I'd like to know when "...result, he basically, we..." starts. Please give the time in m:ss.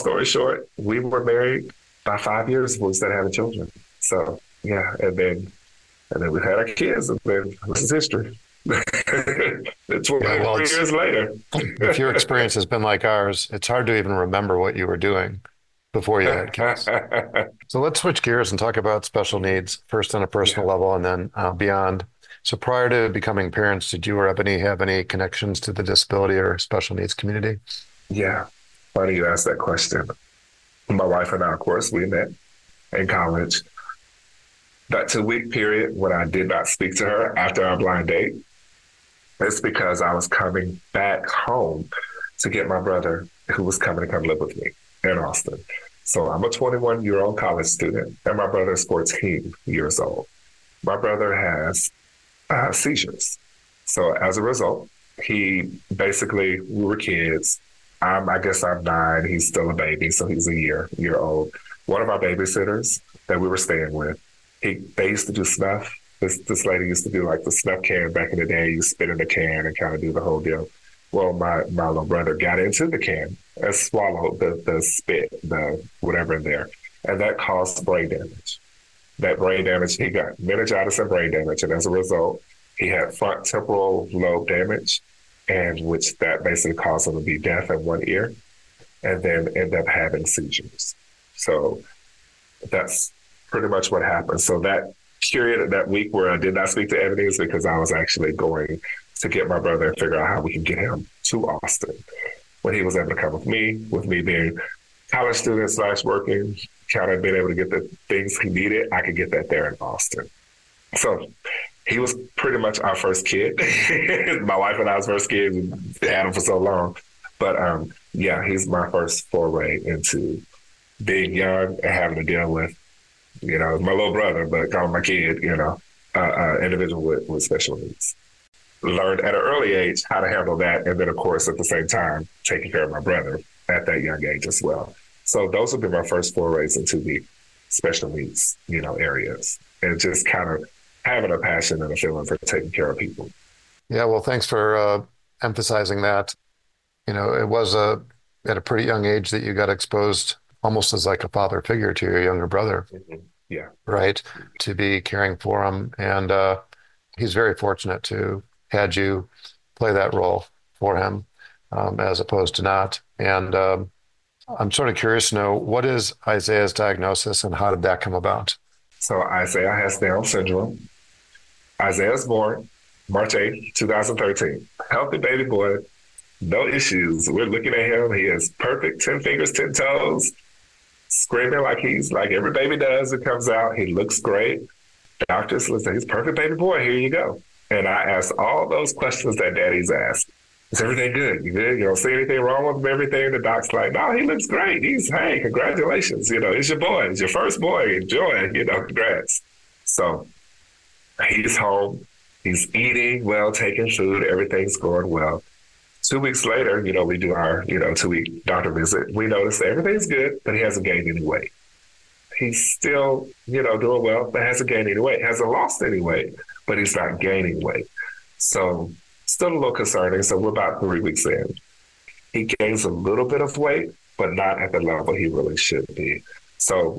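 0:54.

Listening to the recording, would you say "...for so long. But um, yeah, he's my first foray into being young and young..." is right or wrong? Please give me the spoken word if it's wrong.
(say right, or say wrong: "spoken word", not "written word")
wrong: "having", not "young".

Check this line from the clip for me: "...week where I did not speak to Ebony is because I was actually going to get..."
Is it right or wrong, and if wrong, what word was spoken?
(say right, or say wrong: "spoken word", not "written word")
right.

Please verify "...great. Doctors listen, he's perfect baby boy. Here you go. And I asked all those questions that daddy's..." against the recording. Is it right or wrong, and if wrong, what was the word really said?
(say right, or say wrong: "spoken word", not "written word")
right.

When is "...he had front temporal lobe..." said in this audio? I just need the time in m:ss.
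1:22.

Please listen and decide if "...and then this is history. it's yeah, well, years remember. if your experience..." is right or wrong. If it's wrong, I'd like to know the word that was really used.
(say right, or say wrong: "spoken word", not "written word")
wrong: "later", not "remember".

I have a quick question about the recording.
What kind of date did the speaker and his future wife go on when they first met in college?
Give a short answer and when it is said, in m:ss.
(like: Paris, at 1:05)
Blind date, at 0:37.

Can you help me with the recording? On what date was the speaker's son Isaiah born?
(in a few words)
March 8, 2013.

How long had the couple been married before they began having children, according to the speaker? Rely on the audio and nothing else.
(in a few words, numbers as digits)
5 years.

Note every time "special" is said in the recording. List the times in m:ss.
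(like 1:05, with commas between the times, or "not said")
0:19, 0:26, 2:07, 2:17.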